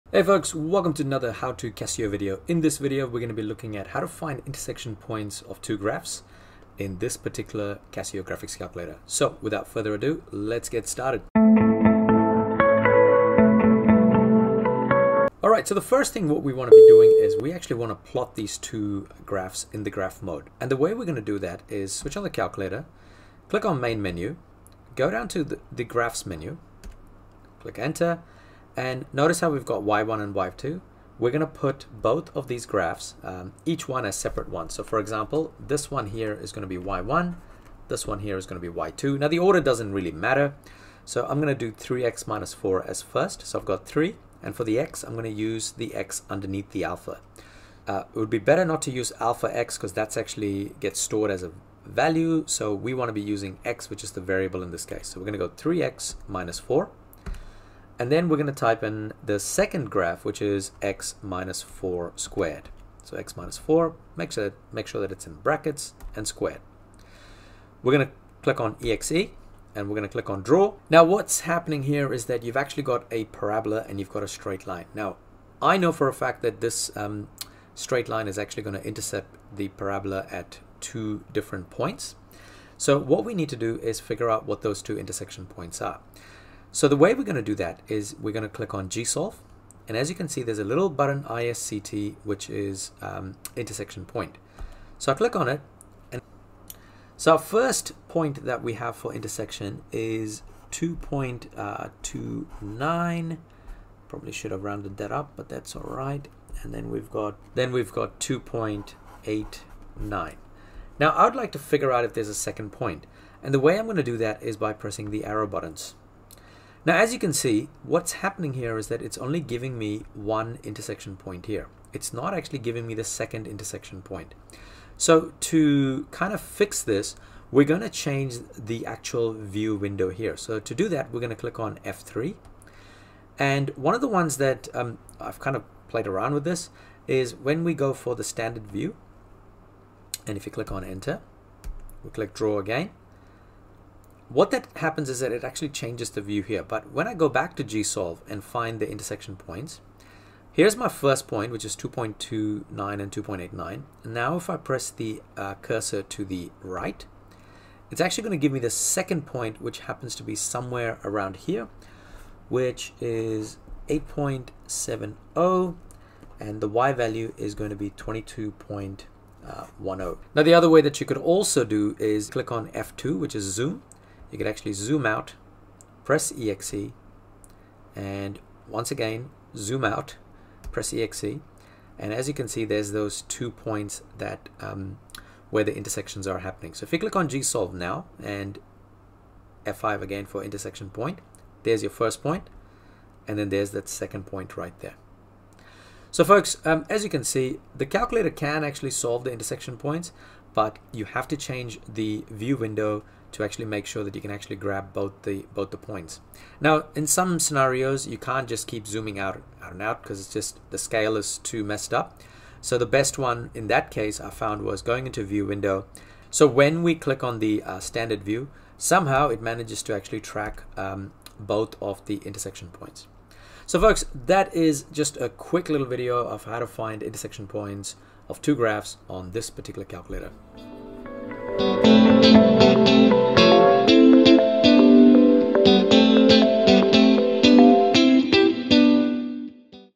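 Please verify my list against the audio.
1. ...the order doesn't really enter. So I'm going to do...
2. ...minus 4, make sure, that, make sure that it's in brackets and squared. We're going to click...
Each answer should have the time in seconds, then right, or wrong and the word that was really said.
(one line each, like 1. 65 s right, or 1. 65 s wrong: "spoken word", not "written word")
1. 39 s wrong: "matter", not "enter"
2. 63 s right.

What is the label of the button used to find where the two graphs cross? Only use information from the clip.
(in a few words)
ISCT.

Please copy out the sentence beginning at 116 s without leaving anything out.
Now, as you can see, what's happening here is that it's only giving me one intersection point here.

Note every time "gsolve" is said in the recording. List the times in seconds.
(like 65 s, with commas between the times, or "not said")
88 s, 147 s, 187 s.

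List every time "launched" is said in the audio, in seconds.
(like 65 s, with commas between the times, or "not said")
not said.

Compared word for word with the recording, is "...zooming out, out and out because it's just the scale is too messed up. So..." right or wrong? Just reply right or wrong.
right.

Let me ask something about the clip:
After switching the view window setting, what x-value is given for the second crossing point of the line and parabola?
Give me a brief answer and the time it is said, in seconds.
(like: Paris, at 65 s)
8.70, at 163 s.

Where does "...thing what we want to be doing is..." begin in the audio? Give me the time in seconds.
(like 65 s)
16 s.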